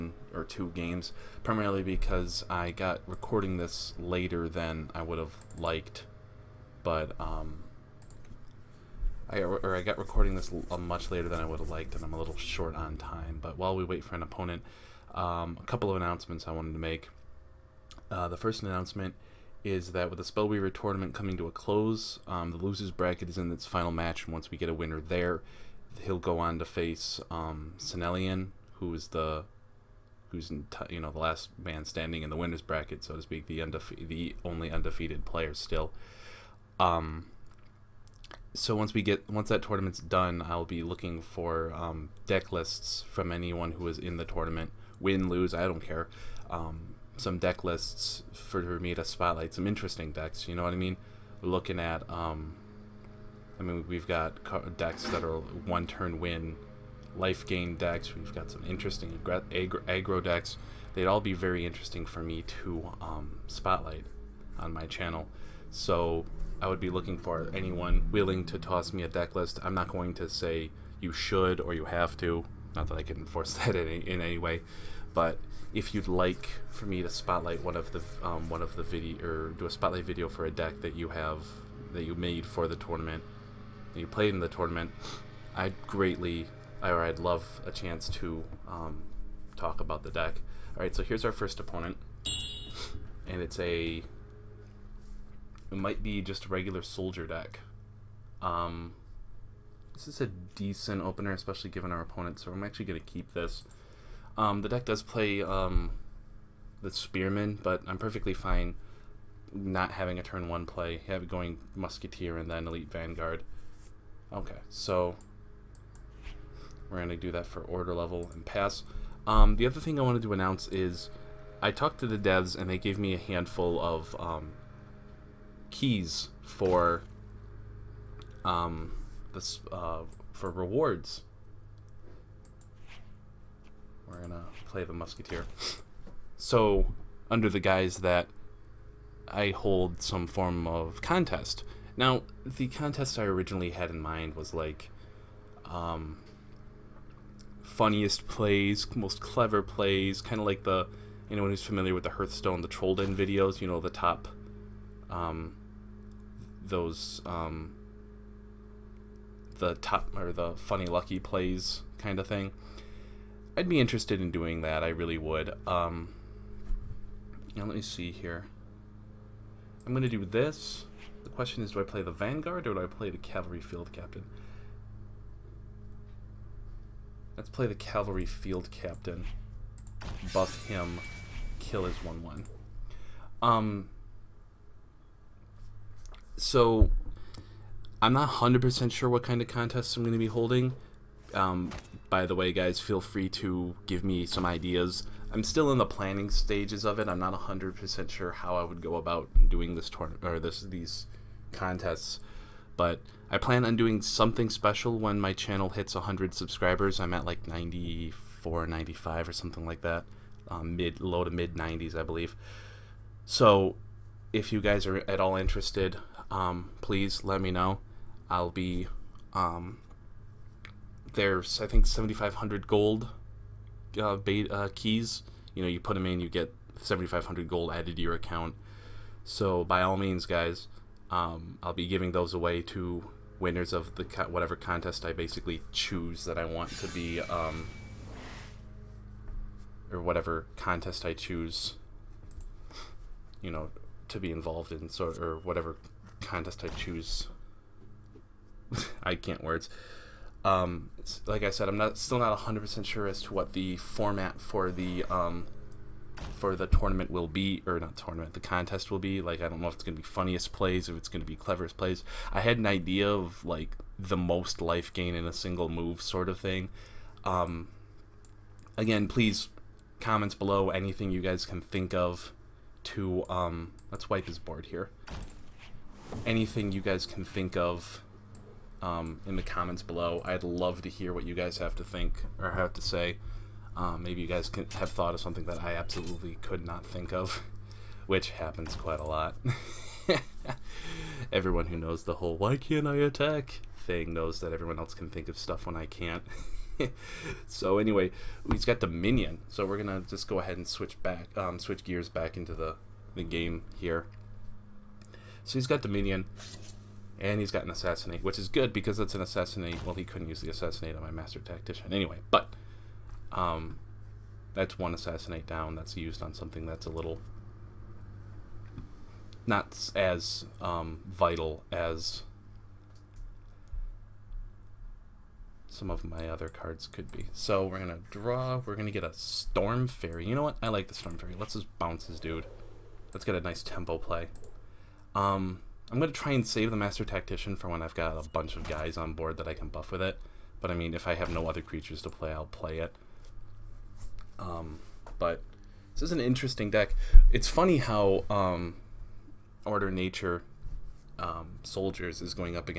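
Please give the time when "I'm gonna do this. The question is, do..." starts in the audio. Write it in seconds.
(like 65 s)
169 s.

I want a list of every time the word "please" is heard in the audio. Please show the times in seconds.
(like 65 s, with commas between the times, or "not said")
216 s, 269 s.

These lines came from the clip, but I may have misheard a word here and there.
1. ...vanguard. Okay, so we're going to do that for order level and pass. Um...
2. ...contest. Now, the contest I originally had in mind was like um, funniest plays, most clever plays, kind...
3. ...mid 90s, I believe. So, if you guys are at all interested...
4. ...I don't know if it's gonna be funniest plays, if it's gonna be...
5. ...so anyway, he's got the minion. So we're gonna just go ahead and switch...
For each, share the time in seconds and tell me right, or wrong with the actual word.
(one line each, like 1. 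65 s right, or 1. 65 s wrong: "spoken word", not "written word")
1. 112 s right
2. 141 s right
3. 211 s right
4. 259 s right
5. 297 s right.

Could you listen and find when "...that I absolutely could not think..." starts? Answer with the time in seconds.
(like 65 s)
285 s.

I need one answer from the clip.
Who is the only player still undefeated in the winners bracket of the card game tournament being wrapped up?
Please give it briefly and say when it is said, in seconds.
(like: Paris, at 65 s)
Senelian, at 27 s.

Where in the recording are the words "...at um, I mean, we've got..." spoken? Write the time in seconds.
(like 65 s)
51 s.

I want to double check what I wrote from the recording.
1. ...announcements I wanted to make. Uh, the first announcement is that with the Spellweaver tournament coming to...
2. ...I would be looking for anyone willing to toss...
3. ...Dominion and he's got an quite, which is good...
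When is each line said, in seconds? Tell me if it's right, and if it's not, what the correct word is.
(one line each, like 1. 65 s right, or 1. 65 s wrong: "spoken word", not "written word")
1. 15 s right
2. 66 s right
3. 305 s wrong: "assassinate", not "quite".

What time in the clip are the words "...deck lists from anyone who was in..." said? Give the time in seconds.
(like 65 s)
42 s.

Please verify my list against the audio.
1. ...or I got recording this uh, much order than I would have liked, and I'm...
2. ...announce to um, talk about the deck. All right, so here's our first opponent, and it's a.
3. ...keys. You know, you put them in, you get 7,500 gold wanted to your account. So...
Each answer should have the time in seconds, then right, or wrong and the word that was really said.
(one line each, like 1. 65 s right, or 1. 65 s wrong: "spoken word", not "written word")
1. 9 s wrong: "later", not "order"
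2. 87 s wrong: "chance", not "announce"
3. 224 s wrong: "added", not "wanted".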